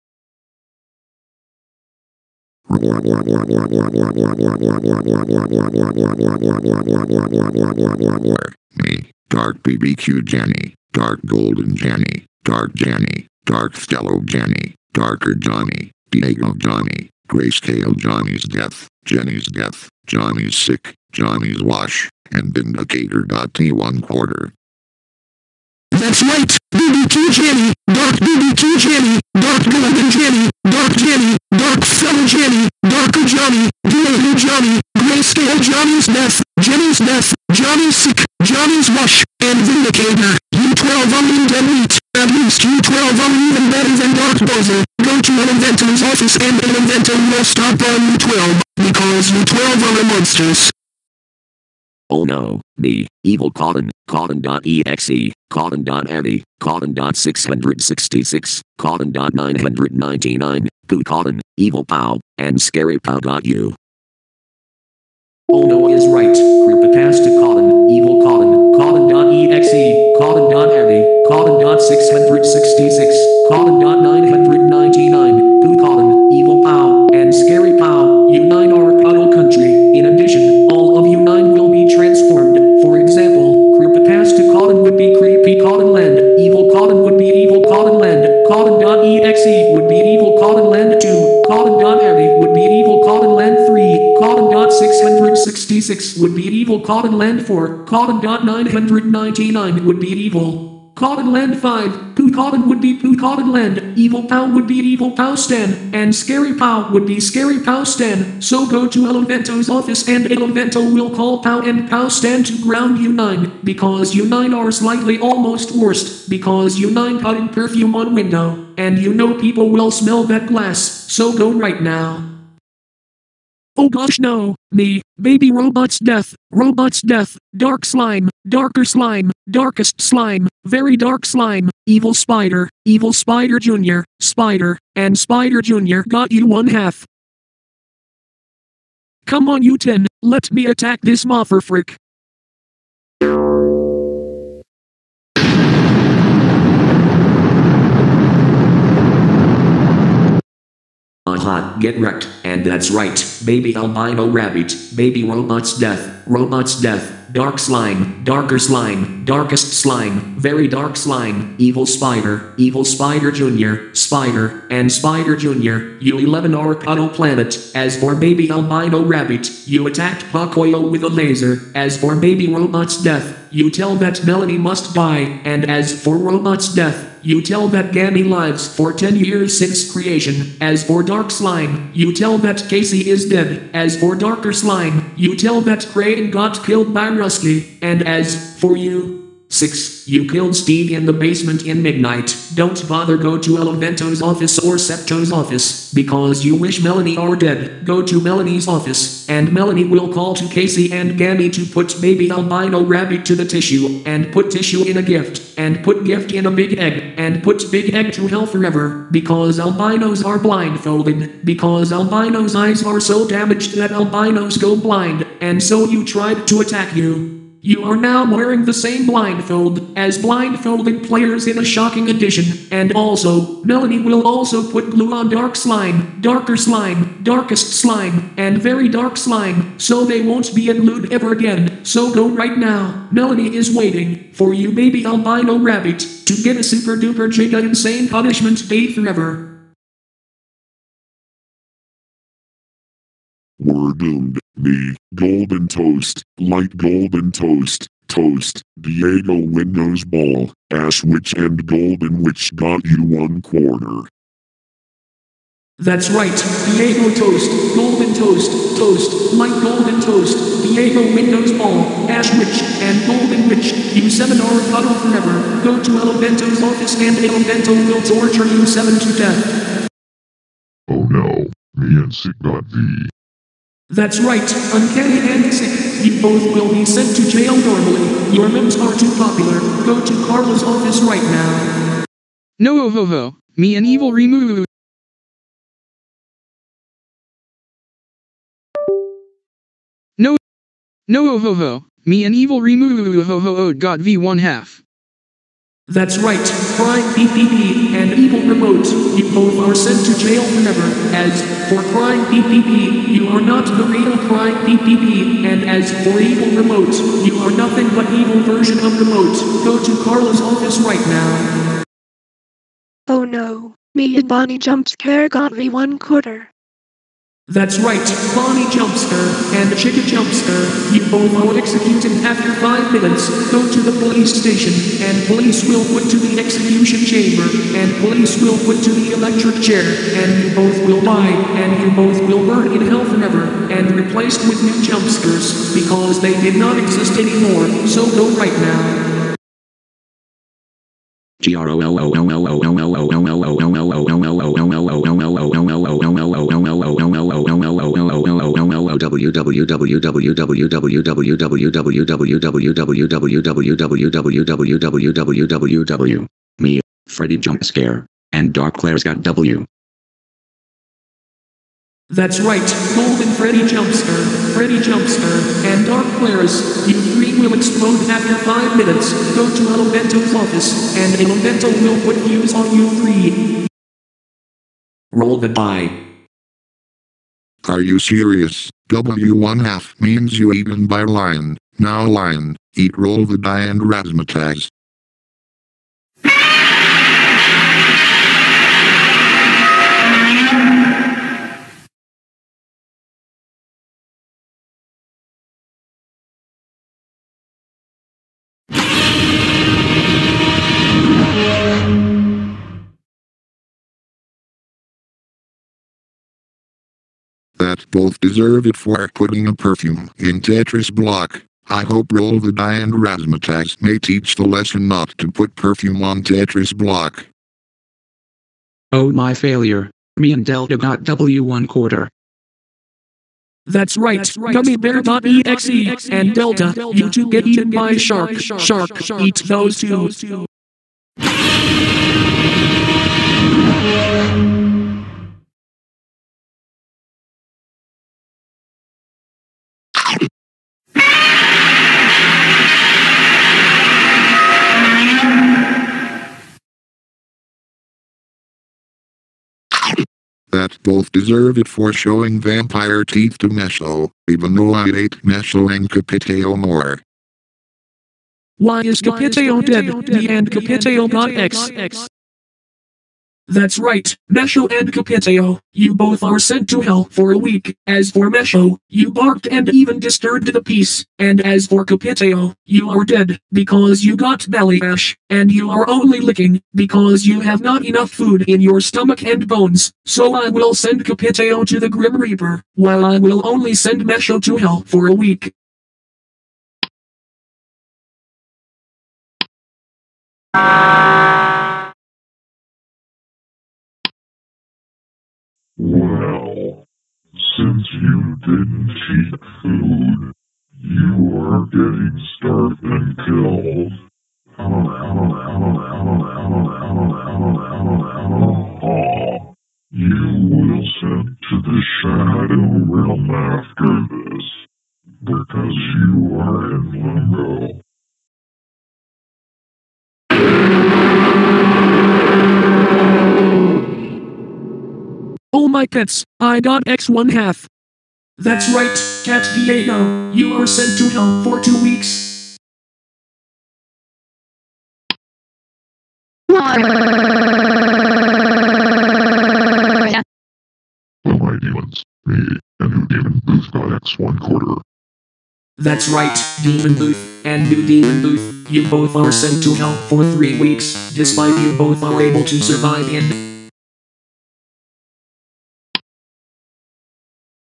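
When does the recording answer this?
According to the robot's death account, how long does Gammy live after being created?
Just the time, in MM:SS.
02:58.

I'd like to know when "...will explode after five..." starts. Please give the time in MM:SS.
06:07.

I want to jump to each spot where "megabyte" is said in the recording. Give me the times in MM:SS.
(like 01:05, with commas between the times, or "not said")
not said.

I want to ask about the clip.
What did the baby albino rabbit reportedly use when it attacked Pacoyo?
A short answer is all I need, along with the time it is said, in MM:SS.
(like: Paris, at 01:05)
a laser, at 02:51.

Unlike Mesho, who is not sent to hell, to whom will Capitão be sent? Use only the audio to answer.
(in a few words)
the Grim Reaper.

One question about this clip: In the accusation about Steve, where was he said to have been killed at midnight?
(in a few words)
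the basement.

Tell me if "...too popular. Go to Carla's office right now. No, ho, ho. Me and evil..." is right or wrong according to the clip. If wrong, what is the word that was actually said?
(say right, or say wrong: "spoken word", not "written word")
right.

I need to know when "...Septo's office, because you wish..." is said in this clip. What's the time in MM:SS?
03:14.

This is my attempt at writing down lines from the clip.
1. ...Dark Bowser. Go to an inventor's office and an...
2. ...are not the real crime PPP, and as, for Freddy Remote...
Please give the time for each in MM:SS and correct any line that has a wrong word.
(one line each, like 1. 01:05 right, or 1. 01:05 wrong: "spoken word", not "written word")
1. 00:44 right
2. 05:03 wrong: "Evil", not "Freddy".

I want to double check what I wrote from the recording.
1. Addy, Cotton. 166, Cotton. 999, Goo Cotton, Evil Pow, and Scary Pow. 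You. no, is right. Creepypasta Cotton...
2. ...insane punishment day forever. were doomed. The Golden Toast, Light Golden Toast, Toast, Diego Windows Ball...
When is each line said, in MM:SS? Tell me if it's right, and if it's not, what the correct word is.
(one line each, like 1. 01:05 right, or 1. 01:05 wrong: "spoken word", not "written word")
1. 00:56 wrong: "666", not "166"
2. 03:57 right.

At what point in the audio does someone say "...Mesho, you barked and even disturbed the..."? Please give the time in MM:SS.
07:48.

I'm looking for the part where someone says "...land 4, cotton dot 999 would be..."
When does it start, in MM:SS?
01:37.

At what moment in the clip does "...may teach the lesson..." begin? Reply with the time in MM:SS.
06:53.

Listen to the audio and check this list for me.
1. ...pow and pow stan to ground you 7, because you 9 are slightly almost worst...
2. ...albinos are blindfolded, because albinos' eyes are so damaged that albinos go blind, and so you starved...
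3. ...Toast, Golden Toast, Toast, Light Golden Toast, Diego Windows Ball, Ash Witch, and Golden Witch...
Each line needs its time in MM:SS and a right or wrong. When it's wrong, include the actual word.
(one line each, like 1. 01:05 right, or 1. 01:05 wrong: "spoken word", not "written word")
1. 01:51 wrong: "9", not "7"
2. 03:29 wrong: "tried", not "starved"
3. 04:17 right.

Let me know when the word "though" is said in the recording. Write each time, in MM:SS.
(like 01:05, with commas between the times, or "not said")
07:34.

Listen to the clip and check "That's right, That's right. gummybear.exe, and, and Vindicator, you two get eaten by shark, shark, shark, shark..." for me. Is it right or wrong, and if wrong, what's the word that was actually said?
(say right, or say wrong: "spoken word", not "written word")
wrong: "Delta", not "Vindicator".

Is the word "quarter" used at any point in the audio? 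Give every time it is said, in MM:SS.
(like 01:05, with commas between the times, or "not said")
00:24, 04:13, 05:15, 07:01, 09:04.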